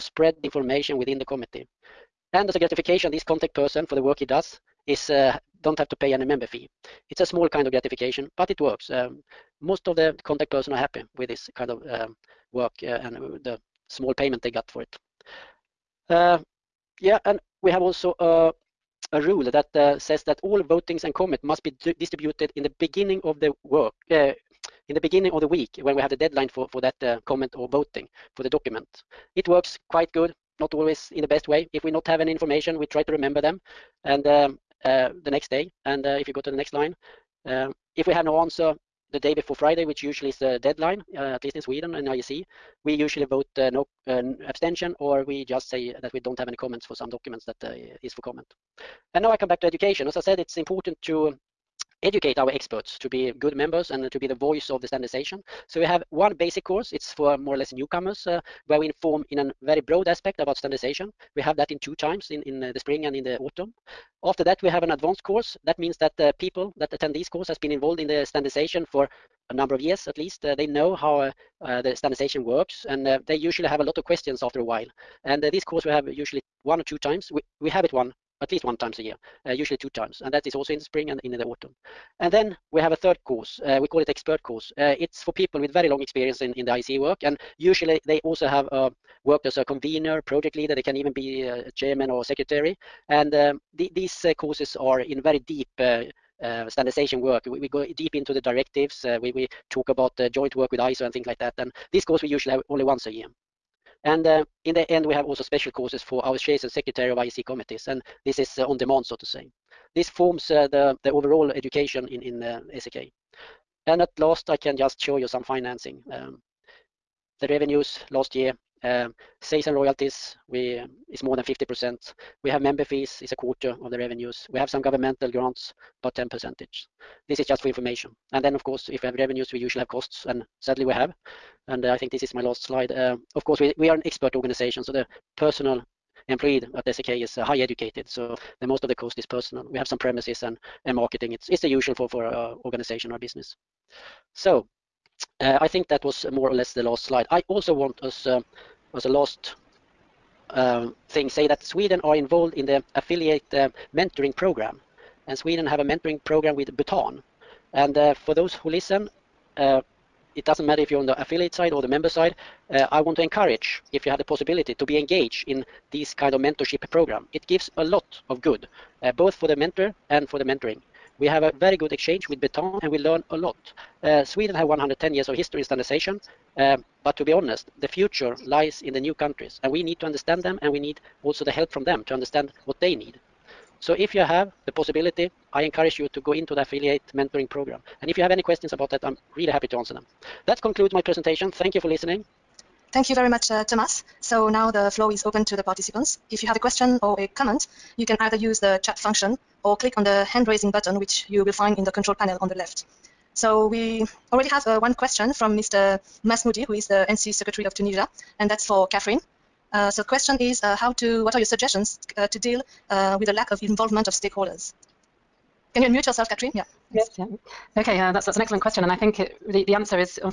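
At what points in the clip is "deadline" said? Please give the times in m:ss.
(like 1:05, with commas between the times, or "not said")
0:26, 0:40.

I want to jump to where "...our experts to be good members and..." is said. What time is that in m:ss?
0:52.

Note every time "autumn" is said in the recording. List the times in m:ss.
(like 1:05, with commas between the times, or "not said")
1:03, 1:21.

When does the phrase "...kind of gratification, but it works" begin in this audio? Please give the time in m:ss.
0:07.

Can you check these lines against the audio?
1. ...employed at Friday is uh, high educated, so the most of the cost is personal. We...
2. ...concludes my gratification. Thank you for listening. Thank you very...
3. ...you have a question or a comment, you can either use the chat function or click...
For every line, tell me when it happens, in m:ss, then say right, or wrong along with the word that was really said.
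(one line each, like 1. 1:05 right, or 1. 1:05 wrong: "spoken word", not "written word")
1. 2:16 wrong: "SEK", not "Friday"
2. 3:10 wrong: "presentation", not "gratification"
3. 3:16 right.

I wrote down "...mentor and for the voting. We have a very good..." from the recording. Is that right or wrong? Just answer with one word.
wrong.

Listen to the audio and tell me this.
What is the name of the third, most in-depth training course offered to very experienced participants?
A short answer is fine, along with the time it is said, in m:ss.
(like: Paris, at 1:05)
Expert course, at 1:24.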